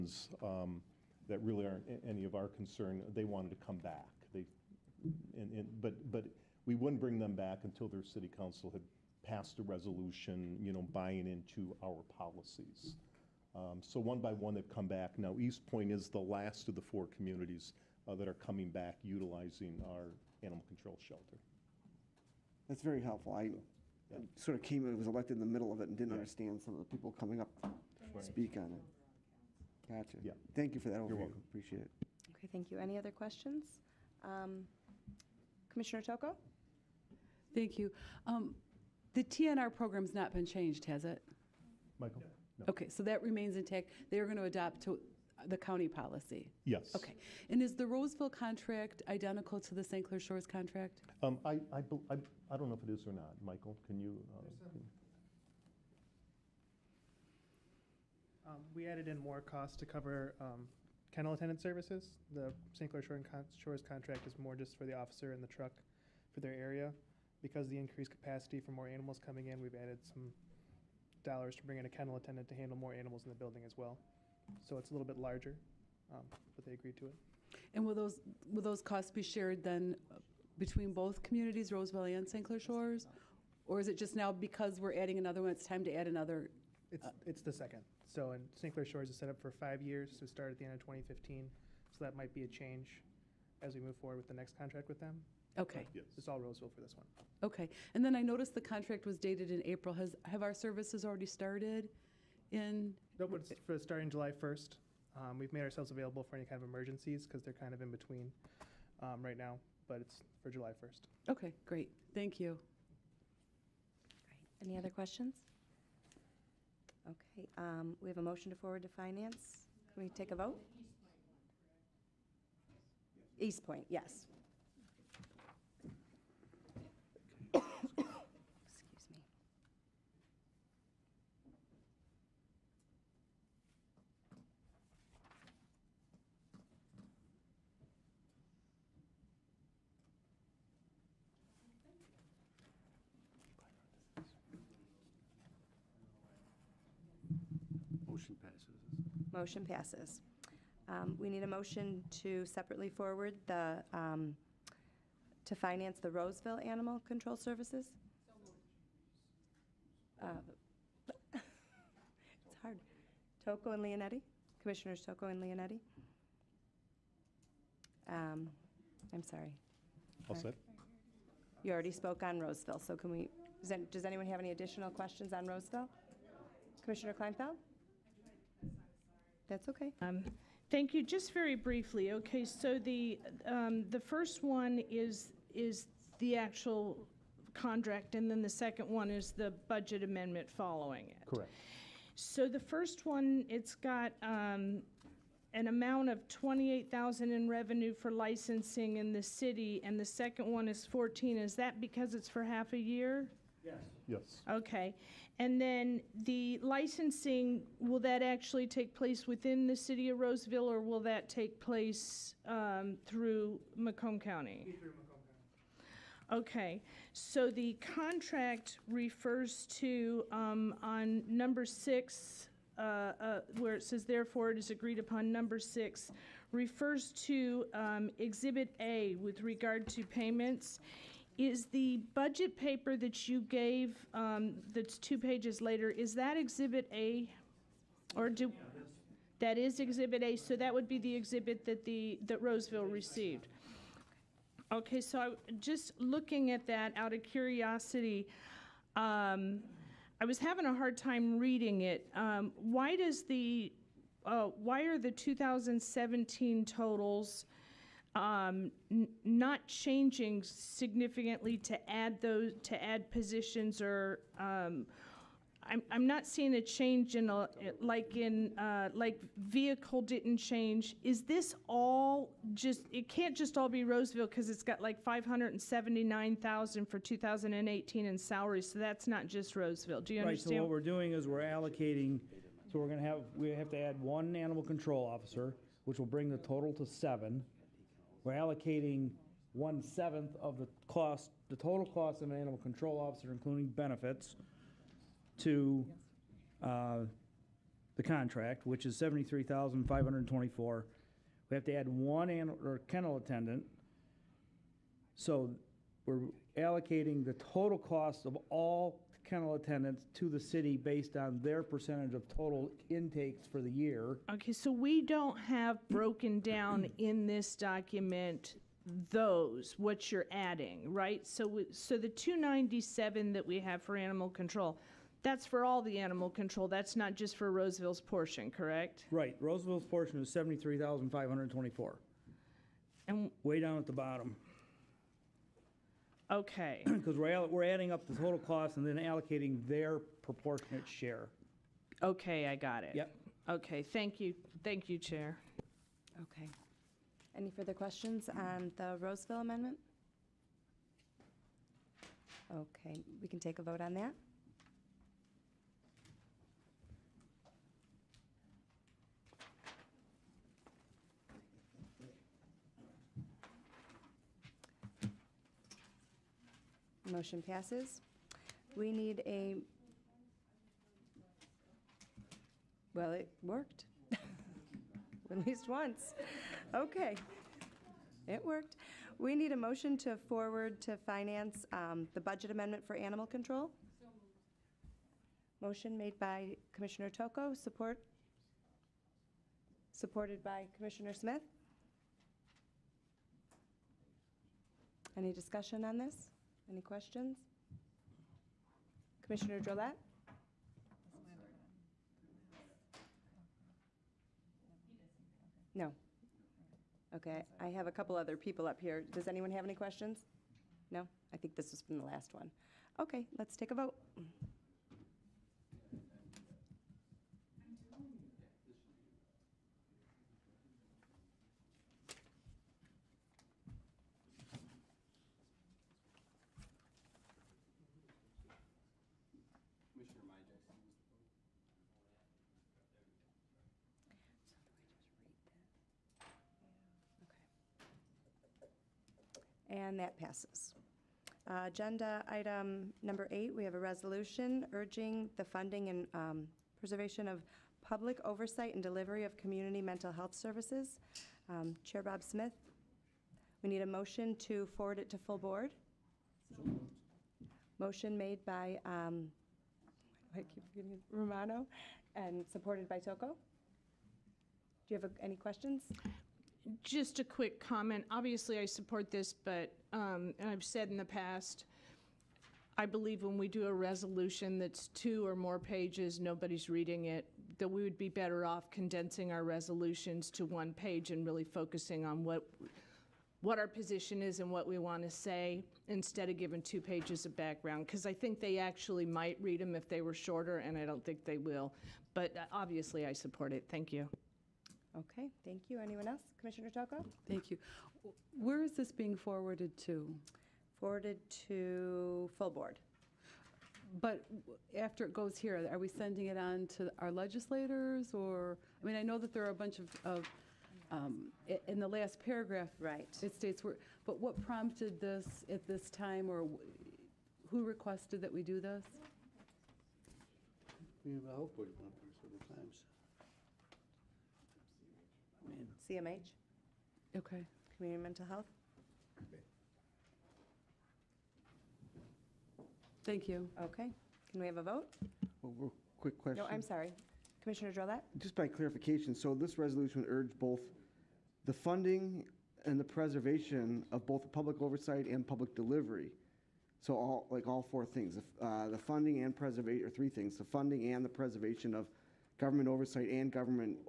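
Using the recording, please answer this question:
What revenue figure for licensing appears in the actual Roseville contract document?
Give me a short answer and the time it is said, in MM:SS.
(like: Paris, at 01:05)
28,000, at 03:16.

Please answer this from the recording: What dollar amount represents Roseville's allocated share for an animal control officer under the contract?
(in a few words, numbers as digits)
$73,524.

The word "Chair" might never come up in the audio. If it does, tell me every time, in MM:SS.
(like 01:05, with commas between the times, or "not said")
05:44, 07:31.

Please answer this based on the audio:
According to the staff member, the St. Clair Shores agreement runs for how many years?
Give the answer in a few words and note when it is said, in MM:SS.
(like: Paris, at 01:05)
5, at 01:29.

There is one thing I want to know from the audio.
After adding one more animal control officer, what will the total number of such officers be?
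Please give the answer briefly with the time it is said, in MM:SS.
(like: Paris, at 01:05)
7, at 04:46.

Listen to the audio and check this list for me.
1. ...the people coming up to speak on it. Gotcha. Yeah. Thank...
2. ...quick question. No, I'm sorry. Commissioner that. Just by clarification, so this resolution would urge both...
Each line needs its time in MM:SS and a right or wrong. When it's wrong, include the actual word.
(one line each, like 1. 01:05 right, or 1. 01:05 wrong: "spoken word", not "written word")
1. 00:26 right
2. 08:55 right.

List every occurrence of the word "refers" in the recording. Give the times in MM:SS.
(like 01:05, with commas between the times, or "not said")
03:38, 03:46.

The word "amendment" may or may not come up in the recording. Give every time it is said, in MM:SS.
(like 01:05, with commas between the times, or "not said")
03:10, 05:49, 06:22.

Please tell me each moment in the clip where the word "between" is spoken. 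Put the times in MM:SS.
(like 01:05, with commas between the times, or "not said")
01:20, 01:47.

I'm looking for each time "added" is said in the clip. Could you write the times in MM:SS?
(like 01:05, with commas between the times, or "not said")
00:58, 01:09.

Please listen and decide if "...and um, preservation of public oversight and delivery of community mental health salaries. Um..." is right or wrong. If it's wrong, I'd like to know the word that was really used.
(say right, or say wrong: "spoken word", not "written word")
wrong: "services", not "salaries".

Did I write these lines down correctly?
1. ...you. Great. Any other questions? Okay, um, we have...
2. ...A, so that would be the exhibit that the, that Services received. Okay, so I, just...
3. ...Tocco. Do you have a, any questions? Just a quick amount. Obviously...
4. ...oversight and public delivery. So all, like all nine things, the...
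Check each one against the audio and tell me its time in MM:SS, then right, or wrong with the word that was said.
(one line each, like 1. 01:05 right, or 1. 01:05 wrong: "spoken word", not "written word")
1. 01:52 right
2. 04:00 wrong: "Roseville", not "Services"
3. 07:42 wrong: "comment", not "amount"
4. 09:04 wrong: "four", not "nine".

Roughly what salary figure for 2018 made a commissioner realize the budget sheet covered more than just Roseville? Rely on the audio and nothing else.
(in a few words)
579,000.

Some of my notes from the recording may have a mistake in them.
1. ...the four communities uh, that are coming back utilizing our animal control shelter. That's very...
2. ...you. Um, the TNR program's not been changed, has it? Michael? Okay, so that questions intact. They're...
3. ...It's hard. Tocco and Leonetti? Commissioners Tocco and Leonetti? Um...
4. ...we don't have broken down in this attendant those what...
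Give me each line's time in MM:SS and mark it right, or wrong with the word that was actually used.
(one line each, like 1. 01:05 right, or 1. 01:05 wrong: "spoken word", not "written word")
1. 00:16 right
2. 00:37 wrong: "remains", not "questions"
3. 02:41 right
4. 05:14 wrong: "document", not "attendant".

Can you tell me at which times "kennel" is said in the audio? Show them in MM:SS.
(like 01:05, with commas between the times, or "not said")
01:01, 01:11, 05:02, 05:09.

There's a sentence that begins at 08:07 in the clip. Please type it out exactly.
Because I think they actually might read them if they were shorter, and I don't think they will.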